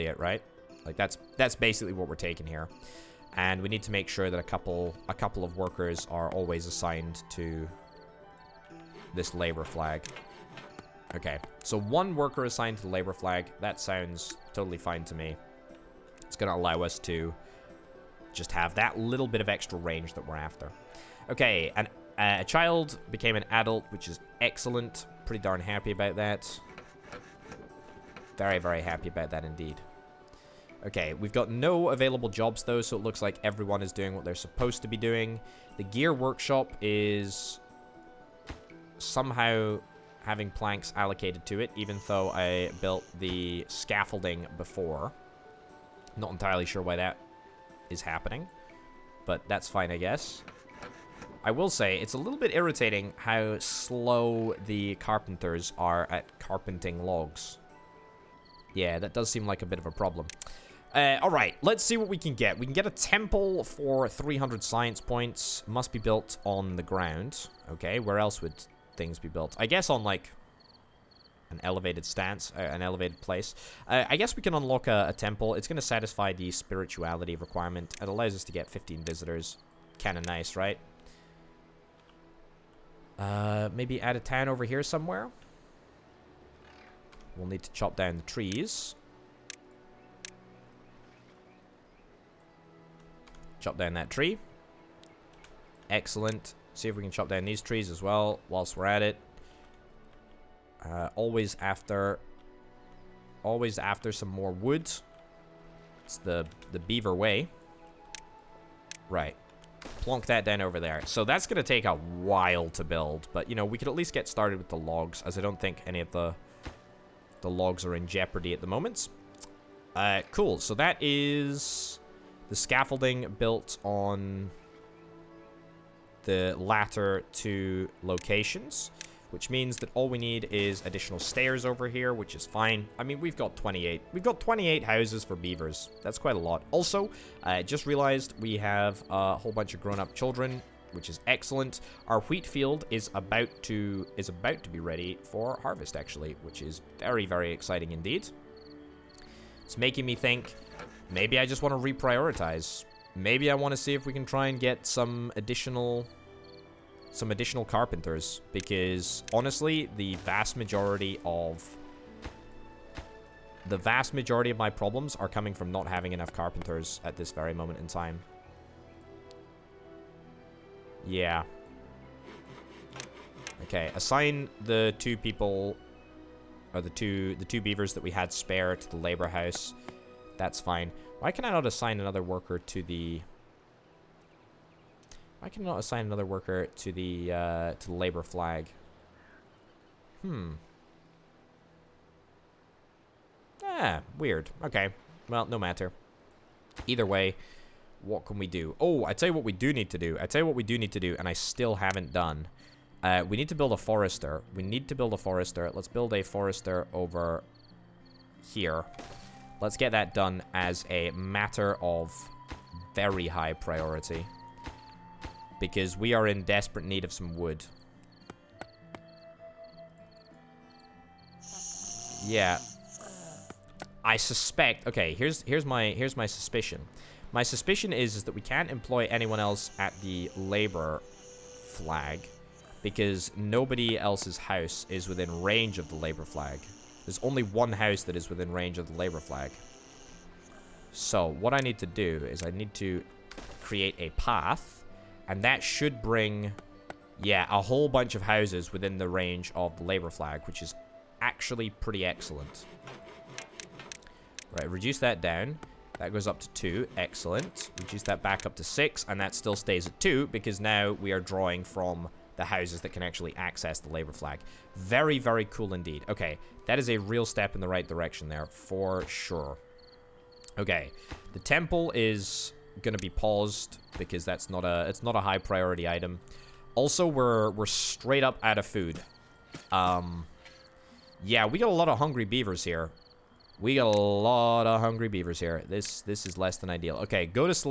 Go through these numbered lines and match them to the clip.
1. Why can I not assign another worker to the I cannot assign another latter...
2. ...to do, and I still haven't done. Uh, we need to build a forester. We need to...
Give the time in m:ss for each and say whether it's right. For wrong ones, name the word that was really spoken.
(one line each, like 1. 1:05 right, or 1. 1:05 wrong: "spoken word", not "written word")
1. 3:01 wrong: "worker", not "latter"
2. 3:20 right.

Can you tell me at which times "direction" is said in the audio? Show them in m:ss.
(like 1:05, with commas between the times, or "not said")
4:27.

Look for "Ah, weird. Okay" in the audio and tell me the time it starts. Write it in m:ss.
3:13.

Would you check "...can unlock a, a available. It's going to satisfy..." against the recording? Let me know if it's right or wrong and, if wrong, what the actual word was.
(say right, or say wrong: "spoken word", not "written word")
wrong: "temple", not "available".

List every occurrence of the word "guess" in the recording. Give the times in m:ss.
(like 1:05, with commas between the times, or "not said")
0:49, 1:09, 1:14.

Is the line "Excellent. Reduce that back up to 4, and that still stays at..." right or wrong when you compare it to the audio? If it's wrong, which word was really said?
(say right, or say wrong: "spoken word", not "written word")
wrong: "6", not "4".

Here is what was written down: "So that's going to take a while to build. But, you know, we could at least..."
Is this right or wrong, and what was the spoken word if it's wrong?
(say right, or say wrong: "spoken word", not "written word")
right.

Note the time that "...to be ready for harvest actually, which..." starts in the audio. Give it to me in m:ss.
2:24.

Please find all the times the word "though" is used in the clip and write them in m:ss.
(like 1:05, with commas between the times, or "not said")
0:32, 0:42.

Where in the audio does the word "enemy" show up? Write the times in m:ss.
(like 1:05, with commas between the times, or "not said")
not said.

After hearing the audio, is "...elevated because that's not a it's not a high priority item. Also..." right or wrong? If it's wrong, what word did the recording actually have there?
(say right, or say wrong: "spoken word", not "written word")
wrong: "paused", not "elevated".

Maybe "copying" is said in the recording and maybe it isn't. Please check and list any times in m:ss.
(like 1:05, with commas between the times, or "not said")
not said.